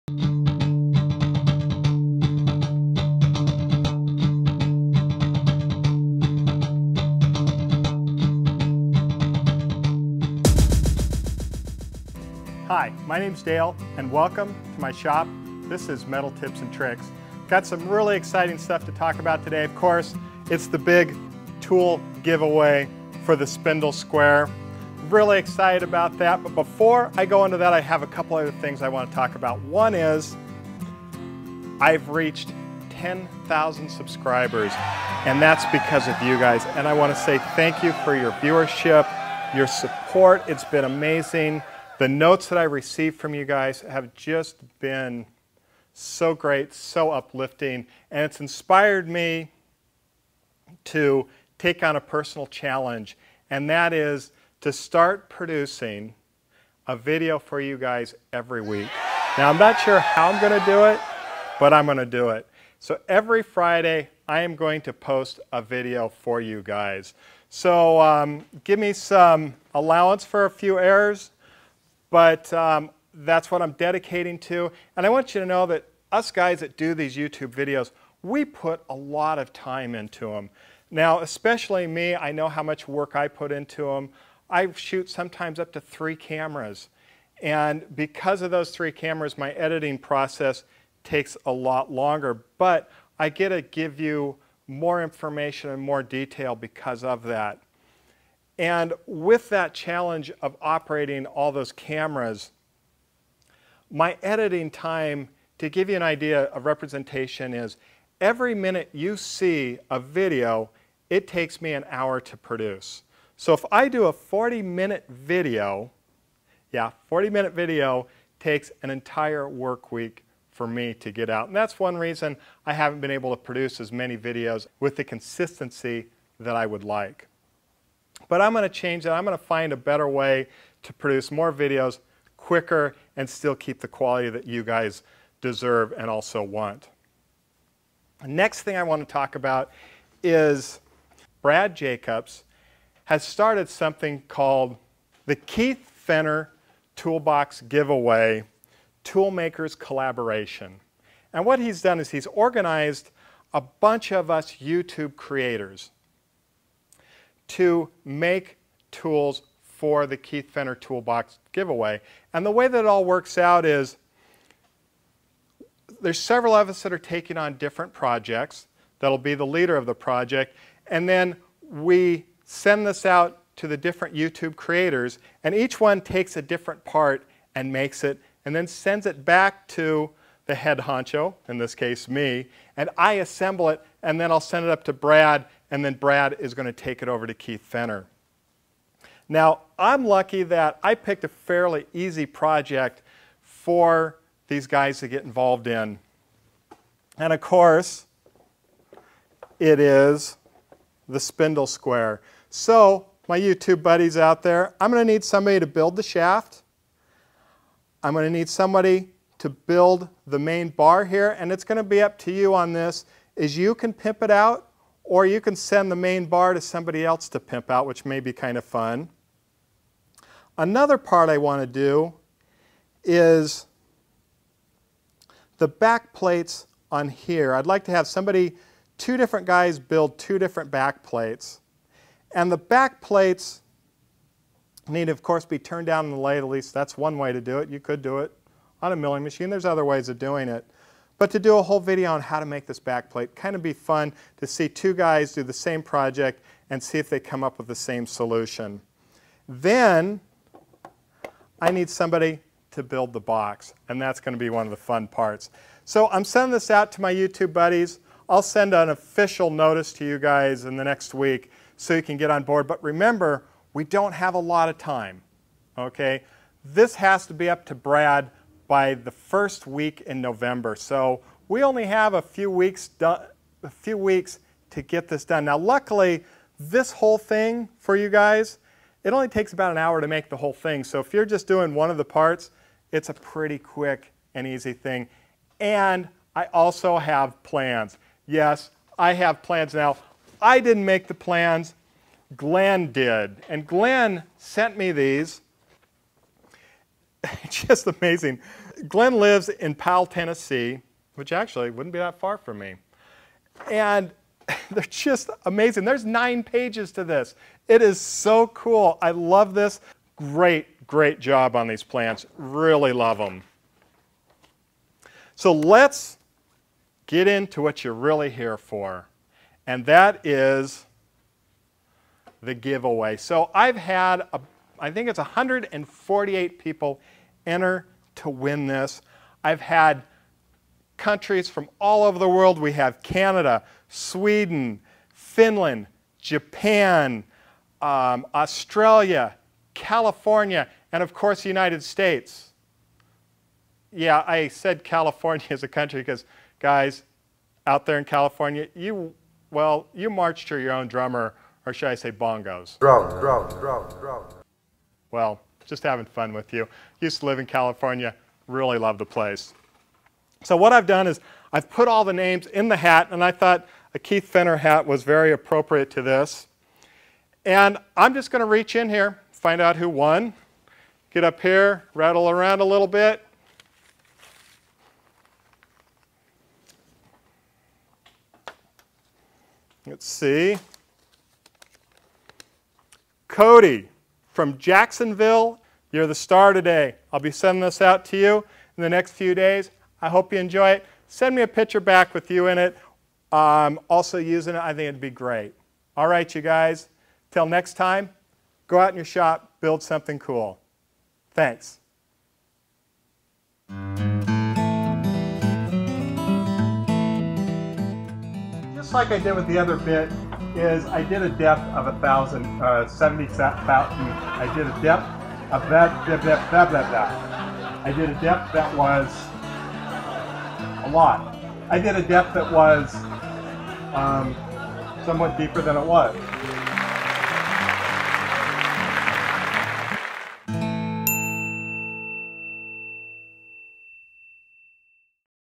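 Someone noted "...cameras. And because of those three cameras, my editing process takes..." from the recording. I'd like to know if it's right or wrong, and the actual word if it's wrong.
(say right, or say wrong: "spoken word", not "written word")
right.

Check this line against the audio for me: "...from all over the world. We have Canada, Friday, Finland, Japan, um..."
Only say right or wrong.
wrong.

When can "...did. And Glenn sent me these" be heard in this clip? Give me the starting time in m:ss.
4:52.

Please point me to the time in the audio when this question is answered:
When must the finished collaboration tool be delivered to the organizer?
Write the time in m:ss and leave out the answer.
4:28.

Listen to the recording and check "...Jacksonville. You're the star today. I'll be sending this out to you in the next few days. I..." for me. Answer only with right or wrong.
right.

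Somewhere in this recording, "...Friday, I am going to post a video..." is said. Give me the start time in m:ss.
1:03.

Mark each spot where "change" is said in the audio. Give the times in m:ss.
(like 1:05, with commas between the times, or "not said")
2:08.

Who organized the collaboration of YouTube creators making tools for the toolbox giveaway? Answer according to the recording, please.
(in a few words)
Brad Jacobs.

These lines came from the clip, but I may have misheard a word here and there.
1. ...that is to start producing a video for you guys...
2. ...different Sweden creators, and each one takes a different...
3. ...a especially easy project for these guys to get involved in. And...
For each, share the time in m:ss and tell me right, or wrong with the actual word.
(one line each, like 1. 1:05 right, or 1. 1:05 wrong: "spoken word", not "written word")
1. 0:53 right
2. 2:53 wrong: "YouTube", not "Sweden"
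3. 3:11 wrong: "fairly", not "especially".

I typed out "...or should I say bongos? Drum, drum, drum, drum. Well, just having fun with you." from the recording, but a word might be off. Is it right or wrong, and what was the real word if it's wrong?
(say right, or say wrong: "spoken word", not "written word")
right.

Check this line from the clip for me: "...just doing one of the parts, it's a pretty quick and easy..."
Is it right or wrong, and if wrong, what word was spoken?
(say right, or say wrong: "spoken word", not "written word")
right.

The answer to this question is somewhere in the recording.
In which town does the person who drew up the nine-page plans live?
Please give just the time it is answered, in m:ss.
4:59.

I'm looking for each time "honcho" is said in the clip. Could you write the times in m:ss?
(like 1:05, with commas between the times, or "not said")
3:00.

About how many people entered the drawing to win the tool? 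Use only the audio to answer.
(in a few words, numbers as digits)
148.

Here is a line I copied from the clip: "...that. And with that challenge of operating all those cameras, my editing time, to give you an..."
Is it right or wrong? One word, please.
right.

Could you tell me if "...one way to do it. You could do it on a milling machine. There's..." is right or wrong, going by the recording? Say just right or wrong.
right.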